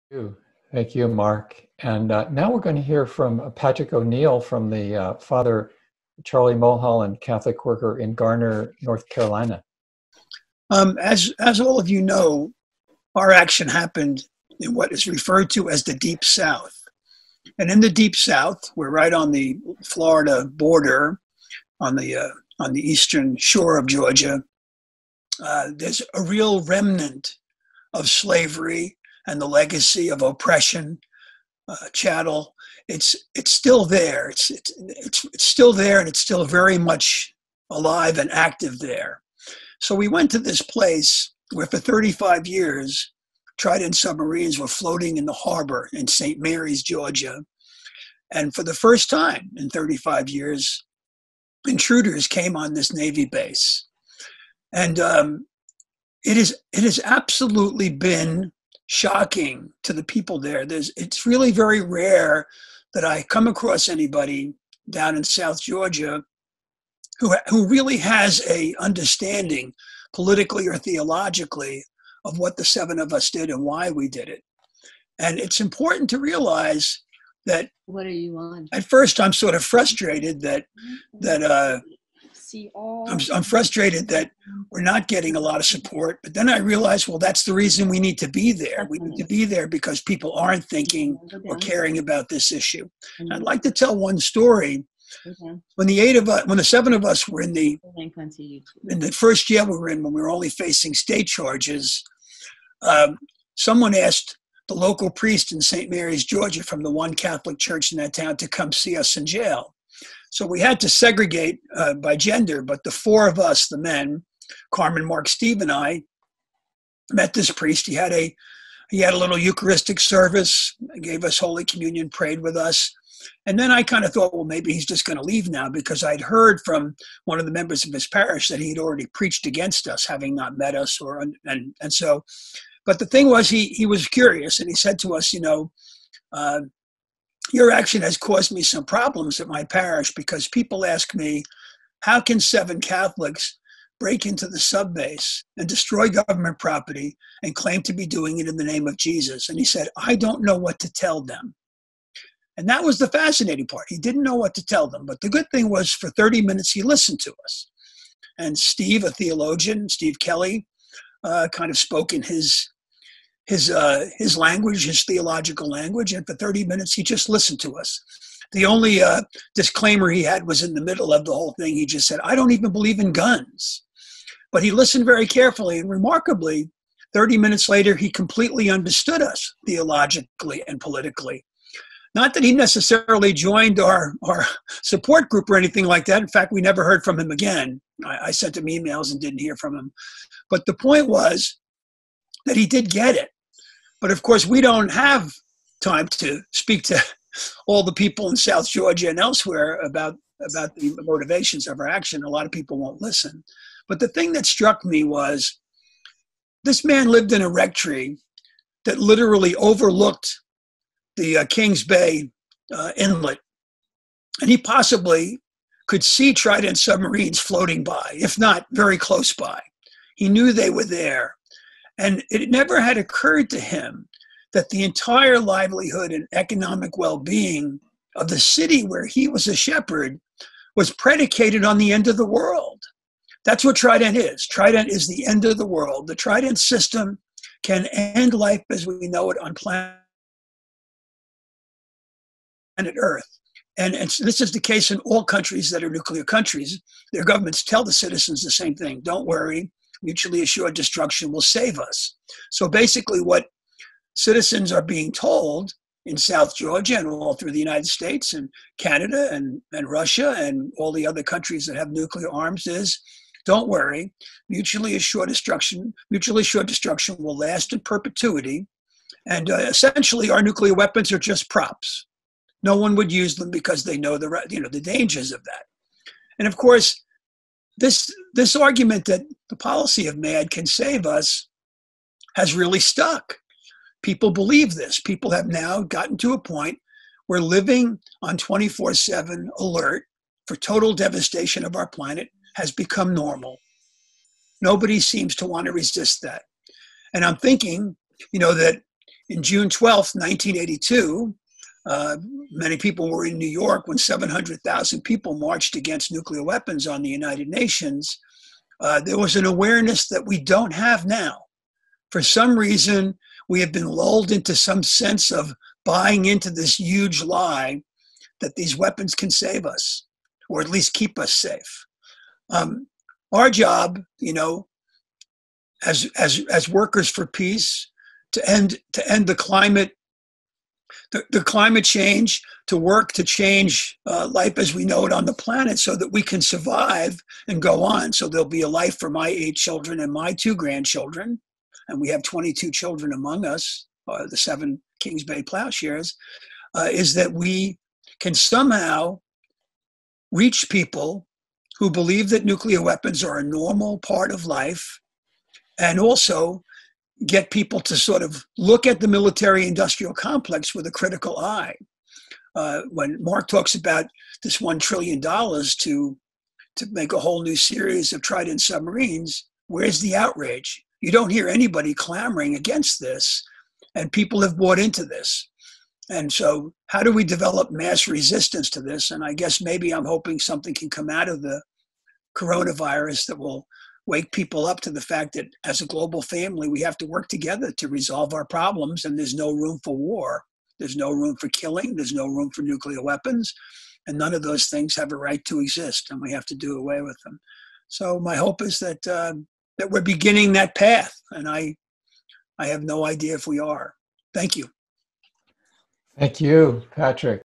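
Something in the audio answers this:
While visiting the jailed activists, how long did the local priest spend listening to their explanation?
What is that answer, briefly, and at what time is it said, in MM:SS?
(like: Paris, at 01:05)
30 minutes, at 02:35.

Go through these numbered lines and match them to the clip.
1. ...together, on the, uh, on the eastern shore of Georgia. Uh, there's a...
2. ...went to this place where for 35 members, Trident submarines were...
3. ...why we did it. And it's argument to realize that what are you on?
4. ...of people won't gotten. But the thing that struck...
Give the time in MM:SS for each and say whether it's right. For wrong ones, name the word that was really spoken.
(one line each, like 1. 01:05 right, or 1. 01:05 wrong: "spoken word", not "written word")
1. 00:20 wrong: "border", not "together"
2. 00:40 wrong: "years", not "members"
3. 01:13 wrong: "important", not "argument"
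4. 03:22 wrong: "listen", not "gotten".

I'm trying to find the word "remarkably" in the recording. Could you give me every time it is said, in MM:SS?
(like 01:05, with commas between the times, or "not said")
02:55.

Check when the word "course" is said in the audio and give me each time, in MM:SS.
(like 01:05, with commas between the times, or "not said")
03:14, 04:36.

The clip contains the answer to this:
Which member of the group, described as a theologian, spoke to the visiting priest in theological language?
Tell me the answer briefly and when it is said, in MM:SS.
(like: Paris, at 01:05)
Steve Kelly, at 02:39.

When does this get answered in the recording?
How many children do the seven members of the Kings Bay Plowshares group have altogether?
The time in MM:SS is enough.
05:42.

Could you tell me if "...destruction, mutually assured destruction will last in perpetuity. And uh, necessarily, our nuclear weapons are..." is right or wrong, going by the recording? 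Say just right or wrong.
wrong.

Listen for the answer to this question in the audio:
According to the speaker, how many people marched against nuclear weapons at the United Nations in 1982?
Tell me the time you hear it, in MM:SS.
05:03.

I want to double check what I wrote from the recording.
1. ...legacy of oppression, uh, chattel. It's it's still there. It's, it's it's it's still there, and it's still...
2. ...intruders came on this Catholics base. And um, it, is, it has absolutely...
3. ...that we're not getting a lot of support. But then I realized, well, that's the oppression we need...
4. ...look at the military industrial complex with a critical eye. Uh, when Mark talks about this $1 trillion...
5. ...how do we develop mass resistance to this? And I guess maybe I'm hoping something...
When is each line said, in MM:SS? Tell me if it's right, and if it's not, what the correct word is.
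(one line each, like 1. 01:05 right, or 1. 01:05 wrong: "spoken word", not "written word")
1. 00:29 right
2. 00:51 wrong: "Navy", not "Catholics"
3. 01:24 wrong: "reason", not "oppression"
4. 05:58 right
5. 06:16 right.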